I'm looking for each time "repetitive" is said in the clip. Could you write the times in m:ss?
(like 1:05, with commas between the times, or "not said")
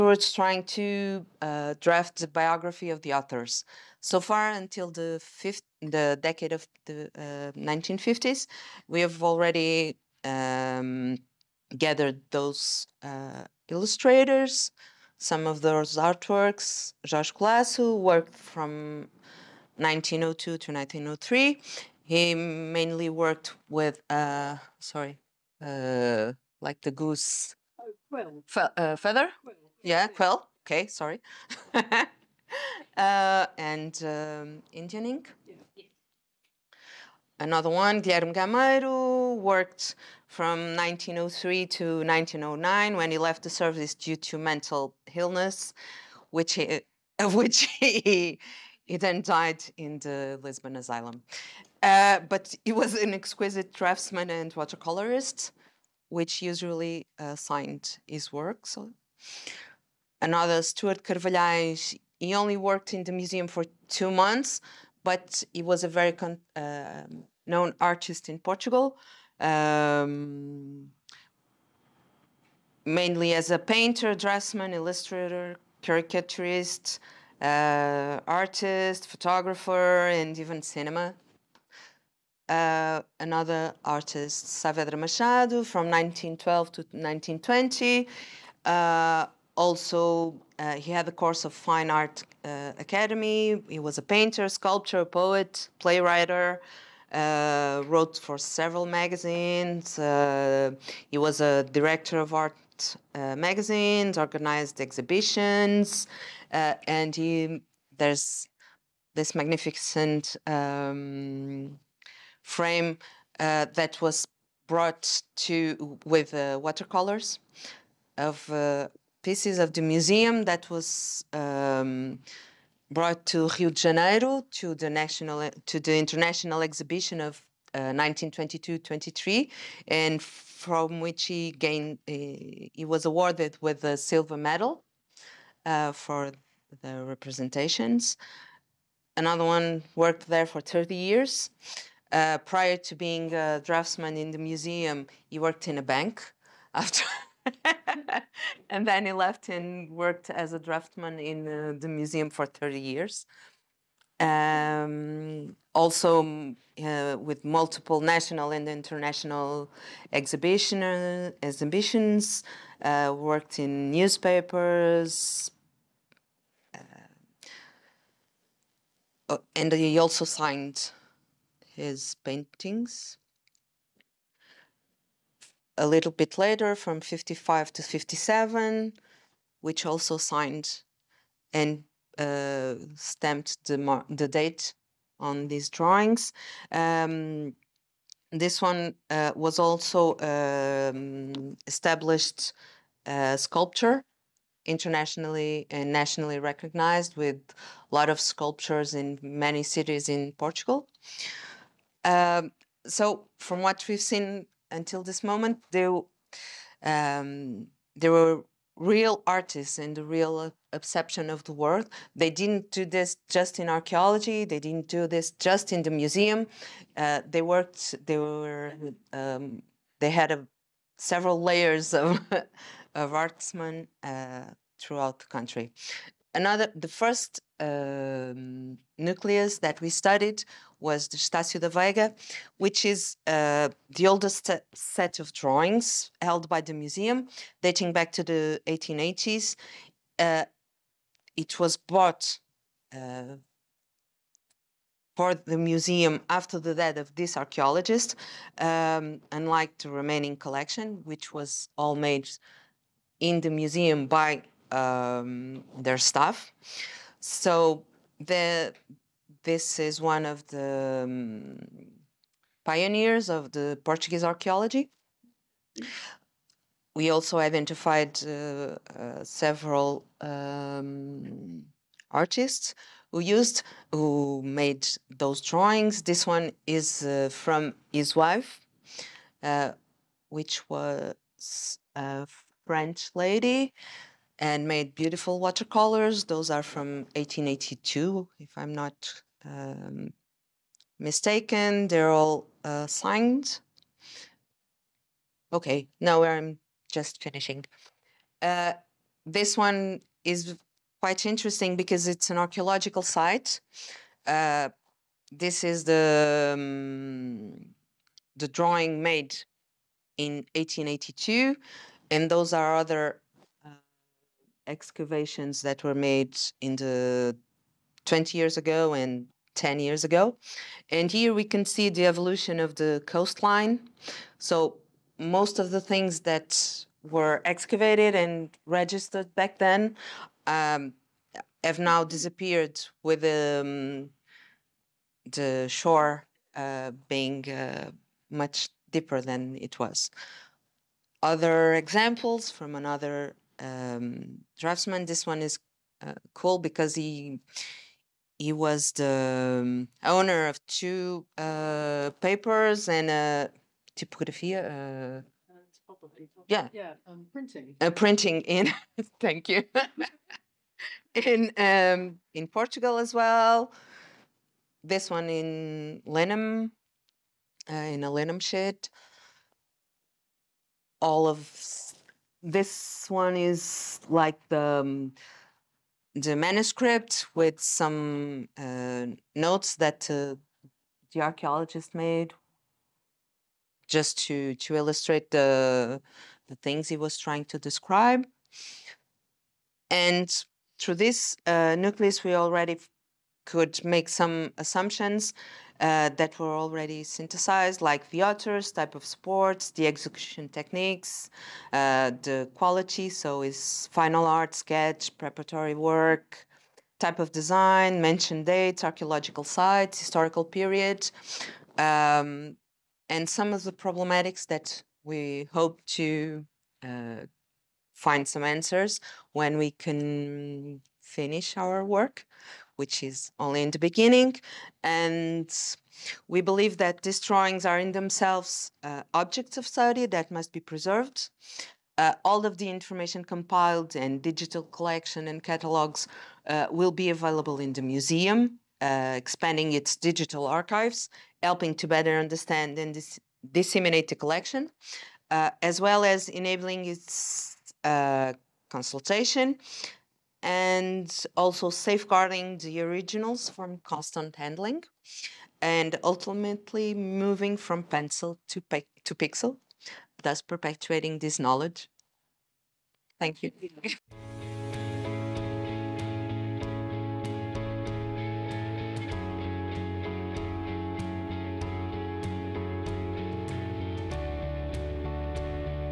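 not said.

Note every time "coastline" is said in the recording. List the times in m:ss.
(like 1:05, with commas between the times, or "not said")
5:23.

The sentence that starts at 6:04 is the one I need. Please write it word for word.
This one in Lenham, uh, in a Lenham shed.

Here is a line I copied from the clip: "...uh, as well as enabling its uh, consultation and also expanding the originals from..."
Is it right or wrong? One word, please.
wrong.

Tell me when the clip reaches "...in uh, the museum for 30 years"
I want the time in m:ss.
2:31.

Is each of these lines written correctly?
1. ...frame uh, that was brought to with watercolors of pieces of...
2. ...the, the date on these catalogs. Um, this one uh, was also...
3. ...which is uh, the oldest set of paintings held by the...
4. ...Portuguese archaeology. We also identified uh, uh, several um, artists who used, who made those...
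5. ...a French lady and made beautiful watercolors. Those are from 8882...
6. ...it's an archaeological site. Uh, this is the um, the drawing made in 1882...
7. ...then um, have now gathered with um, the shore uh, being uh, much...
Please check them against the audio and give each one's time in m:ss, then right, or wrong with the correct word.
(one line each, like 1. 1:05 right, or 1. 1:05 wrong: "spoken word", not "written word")
1. 1:52 right
2. 3:03 wrong: "drawings", not "catalogs"
3. 3:52 wrong: "drawings", not "paintings"
4. 4:23 right
5. 4:41 wrong: "1882", not "8882"
6. 5:02 right
7. 5:29 wrong: "disappeared", not "gathered".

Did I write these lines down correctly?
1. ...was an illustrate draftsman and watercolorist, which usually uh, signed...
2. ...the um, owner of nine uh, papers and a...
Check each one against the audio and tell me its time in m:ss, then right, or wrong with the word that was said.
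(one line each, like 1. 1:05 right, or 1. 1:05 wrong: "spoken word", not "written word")
1. 0:52 wrong: "exquisite", not "illustrate"
2. 5:48 wrong: "two", not "nine".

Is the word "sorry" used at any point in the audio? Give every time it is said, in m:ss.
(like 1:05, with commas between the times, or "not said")
0:24, 0:30.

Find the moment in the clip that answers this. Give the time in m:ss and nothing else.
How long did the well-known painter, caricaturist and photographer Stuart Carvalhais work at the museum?
1:03.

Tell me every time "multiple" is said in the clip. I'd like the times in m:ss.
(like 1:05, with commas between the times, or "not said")
2:37.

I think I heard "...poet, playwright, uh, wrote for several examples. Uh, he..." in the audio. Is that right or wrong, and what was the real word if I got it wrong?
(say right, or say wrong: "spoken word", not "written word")
wrong: "magazines", not "examples".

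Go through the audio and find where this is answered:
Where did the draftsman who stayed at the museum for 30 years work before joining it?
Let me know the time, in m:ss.
2:25.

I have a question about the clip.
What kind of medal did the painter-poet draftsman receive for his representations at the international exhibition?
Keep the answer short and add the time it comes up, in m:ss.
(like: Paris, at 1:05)
Silver medal, at 2:13.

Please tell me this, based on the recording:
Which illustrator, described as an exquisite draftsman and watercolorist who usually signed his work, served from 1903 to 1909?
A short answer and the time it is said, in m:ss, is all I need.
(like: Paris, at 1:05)
Guilherme Gameiro, at 0:38.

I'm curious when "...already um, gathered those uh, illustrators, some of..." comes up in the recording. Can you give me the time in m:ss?
0:09.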